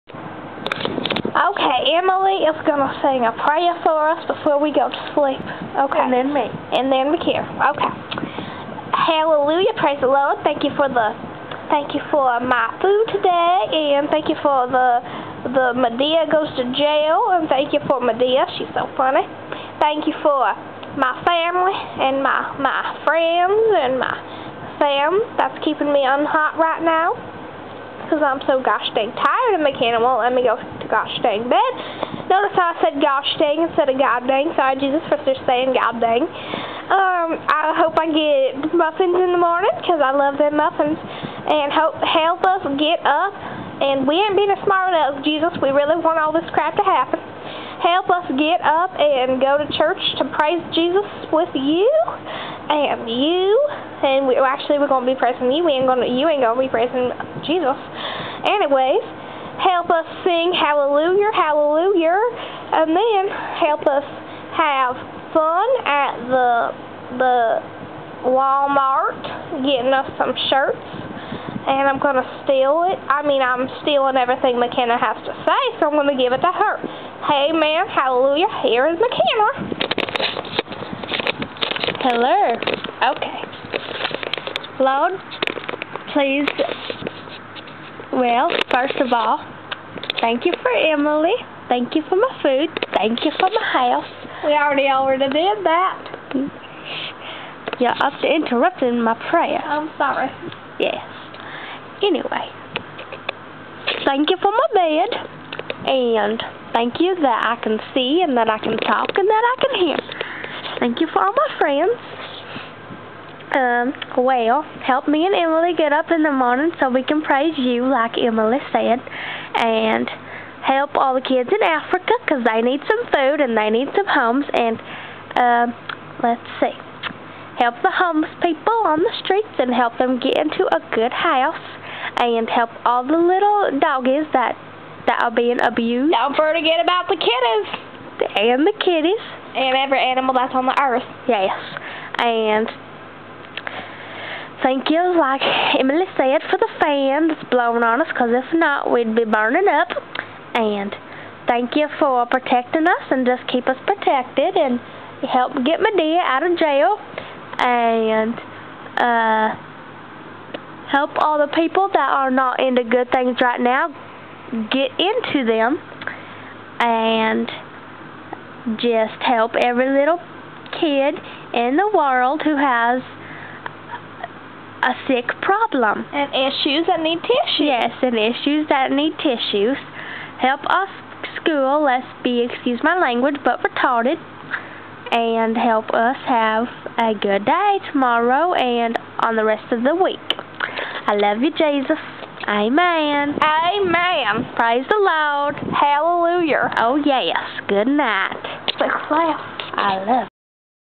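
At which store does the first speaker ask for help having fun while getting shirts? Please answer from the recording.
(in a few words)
Walmart.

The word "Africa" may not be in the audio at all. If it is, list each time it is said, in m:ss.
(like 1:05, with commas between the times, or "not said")
2:01.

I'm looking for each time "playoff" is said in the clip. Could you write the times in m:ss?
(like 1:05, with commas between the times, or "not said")
not said.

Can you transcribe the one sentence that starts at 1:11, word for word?
And I'm going to steal it.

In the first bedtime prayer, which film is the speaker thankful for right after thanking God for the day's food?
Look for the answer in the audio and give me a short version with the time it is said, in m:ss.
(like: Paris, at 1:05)
Madea Goes to Jail, at 0:15.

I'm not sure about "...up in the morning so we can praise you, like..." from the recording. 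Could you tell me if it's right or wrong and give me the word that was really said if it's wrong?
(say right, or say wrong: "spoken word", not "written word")
right.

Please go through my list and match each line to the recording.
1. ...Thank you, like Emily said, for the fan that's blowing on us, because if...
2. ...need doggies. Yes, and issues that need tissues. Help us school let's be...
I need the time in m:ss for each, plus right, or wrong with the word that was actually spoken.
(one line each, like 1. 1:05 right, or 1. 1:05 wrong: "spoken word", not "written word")
1. 2:24 right
2. 2:57 wrong: "tissues", not "doggies".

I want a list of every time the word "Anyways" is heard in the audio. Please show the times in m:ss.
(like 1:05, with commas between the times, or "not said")
0:58, 1:42.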